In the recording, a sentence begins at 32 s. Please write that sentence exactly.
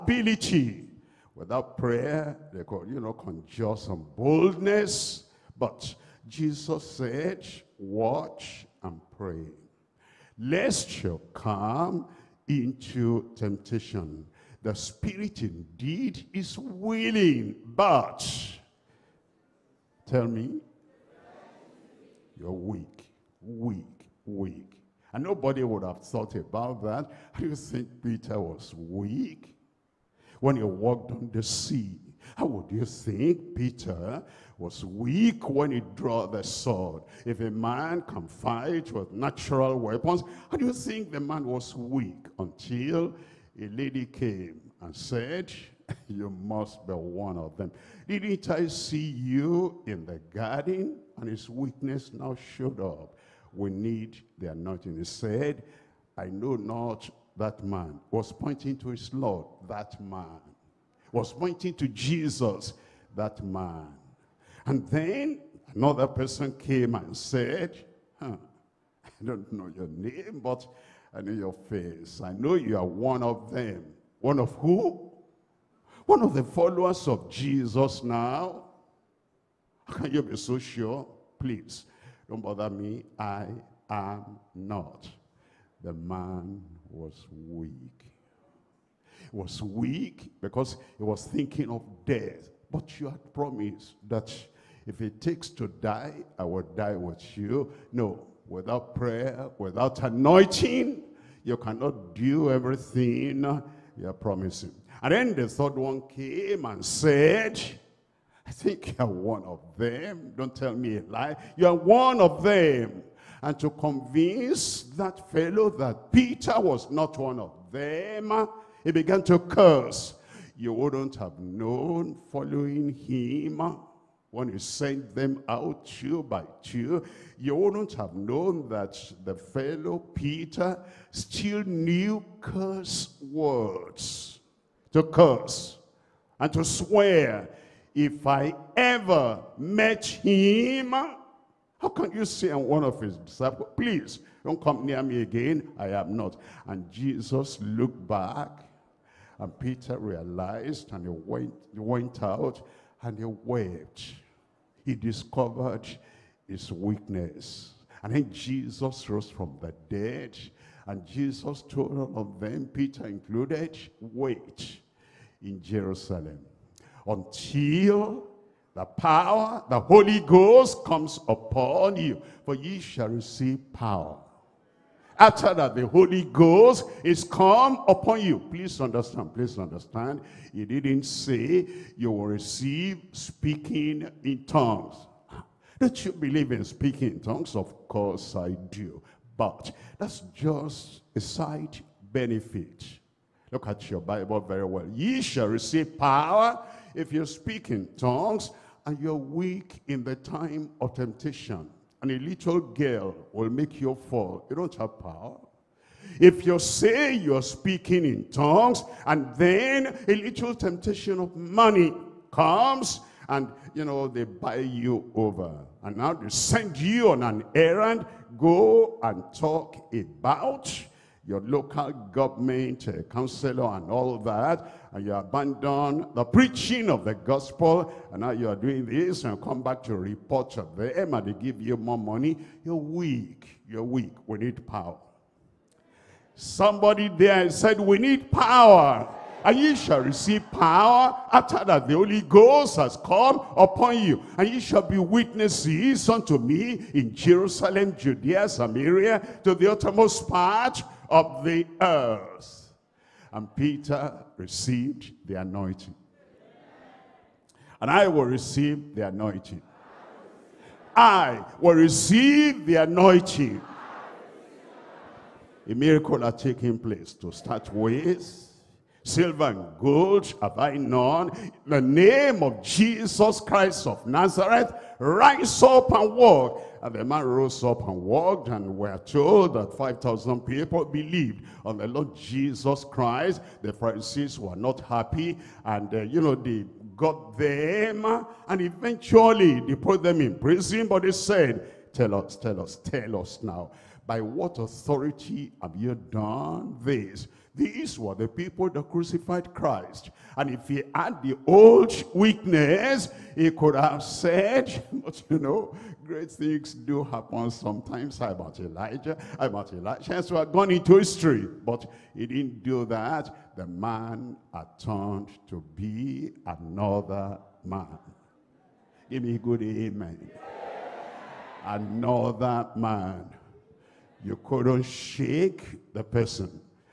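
How would you think Peter was weak when he drew the sword?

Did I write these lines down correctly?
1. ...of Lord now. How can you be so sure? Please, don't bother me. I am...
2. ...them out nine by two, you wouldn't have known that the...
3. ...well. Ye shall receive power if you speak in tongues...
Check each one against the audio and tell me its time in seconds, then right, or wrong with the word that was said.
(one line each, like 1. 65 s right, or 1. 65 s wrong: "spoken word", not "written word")
1. 77 s wrong: "Jesus", not "Lord"
2. 125 s wrong: "two", not "nine"
3. 194 s right.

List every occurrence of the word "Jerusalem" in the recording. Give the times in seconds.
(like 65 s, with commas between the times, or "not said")
165 s, 247 s.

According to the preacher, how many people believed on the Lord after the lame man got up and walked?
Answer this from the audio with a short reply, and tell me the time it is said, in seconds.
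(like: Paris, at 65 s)
5,000, at 279 s.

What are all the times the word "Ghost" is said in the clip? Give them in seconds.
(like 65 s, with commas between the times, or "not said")
170 s, 176 s, 242 s.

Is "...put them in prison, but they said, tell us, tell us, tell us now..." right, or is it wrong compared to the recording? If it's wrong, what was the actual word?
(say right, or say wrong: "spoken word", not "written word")
right.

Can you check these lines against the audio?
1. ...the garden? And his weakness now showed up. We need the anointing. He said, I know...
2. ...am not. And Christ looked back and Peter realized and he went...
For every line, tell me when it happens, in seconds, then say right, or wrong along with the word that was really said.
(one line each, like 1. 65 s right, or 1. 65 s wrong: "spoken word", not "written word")
1. 50 s right
2. 145 s wrong: "Jesus", not "Christ".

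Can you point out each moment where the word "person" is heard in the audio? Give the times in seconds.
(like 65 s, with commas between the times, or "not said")
66 s, 326 s.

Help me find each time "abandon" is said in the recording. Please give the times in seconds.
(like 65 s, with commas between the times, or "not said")
225 s.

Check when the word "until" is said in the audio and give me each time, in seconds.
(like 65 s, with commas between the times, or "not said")
42 s, 167 s.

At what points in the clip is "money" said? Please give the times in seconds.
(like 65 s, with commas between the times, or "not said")
211 s, 231 s.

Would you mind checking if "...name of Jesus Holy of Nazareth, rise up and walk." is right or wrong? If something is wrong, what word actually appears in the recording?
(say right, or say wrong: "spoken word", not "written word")
wrong: "Christ", not "Holy".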